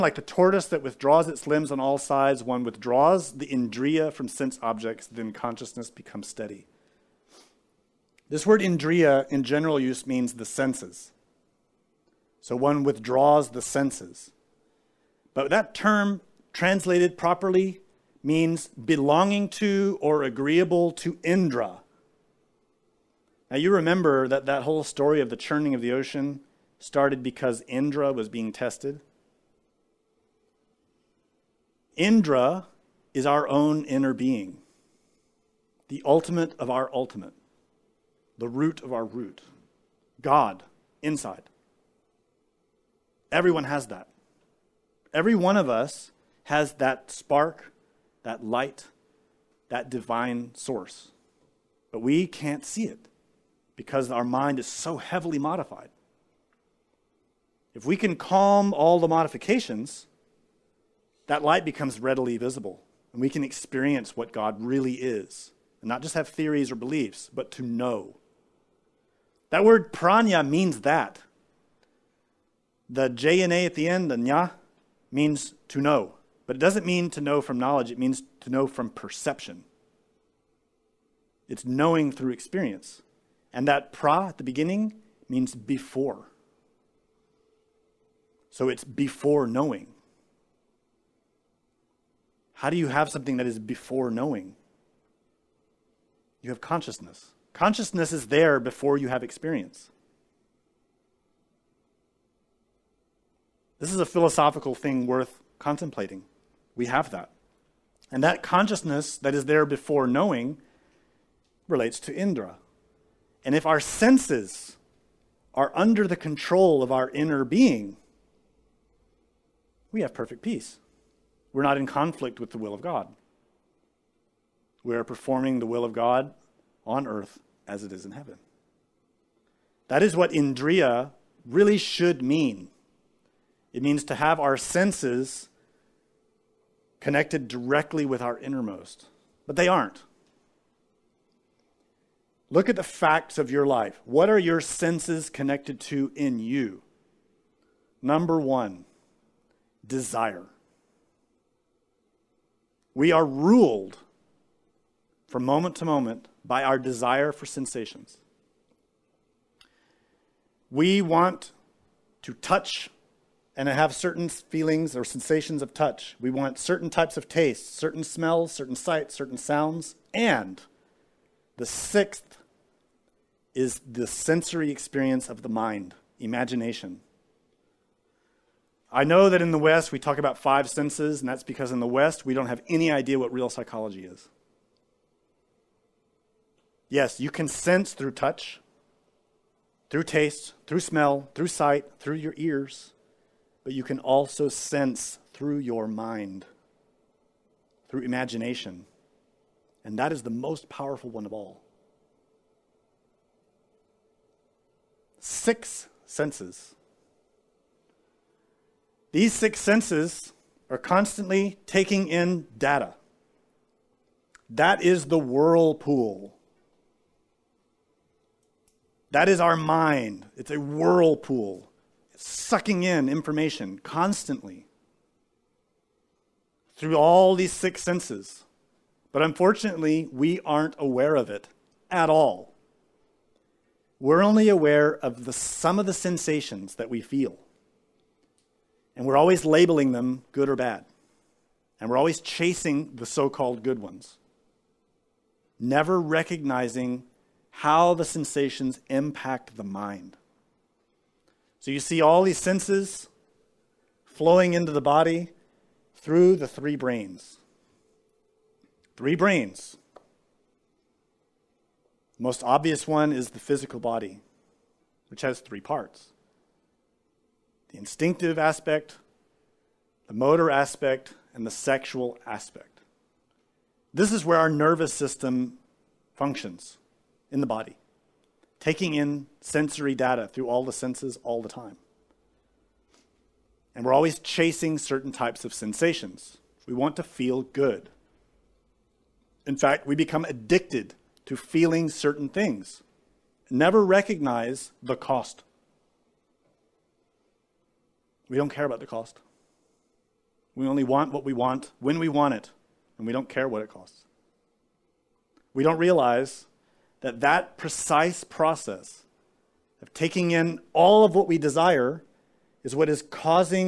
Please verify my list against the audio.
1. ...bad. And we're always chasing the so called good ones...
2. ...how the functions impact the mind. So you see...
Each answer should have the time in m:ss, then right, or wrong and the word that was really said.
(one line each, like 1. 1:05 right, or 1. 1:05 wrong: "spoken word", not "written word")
1. 4:00 right
2. 4:07 wrong: "sensations", not "functions".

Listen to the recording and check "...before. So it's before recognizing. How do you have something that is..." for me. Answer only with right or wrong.
wrong.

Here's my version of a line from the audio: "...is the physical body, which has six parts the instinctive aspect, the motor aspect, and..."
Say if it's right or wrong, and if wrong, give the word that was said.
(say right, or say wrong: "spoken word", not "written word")
wrong: "three", not "six".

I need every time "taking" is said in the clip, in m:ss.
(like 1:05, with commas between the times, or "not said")
3:31, 4:38, 5:09.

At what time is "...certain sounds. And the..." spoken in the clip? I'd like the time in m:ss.
2:49.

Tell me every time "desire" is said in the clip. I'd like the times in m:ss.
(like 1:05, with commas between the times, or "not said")
2:29, 2:36, 5:11.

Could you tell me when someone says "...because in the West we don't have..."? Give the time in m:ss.
3:01.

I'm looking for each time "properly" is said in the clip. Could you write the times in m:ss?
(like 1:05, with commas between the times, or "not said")
0:17.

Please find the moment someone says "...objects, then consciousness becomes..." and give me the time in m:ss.
0:04.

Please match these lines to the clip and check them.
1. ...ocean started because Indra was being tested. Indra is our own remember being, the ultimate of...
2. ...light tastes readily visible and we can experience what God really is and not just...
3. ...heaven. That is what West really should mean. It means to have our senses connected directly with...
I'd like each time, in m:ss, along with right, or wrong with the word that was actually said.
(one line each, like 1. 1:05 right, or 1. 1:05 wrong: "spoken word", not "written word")
1. 0:25 wrong: "inner", not "remember"
2. 1:01 wrong: "becomes", not "tastes"
3. 2:08 wrong: "Indriya", not "West".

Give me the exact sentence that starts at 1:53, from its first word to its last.
And if our senses are under the control of our inner being, we have perfect peace.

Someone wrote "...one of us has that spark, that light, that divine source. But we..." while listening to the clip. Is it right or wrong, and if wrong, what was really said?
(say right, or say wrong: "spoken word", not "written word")
right.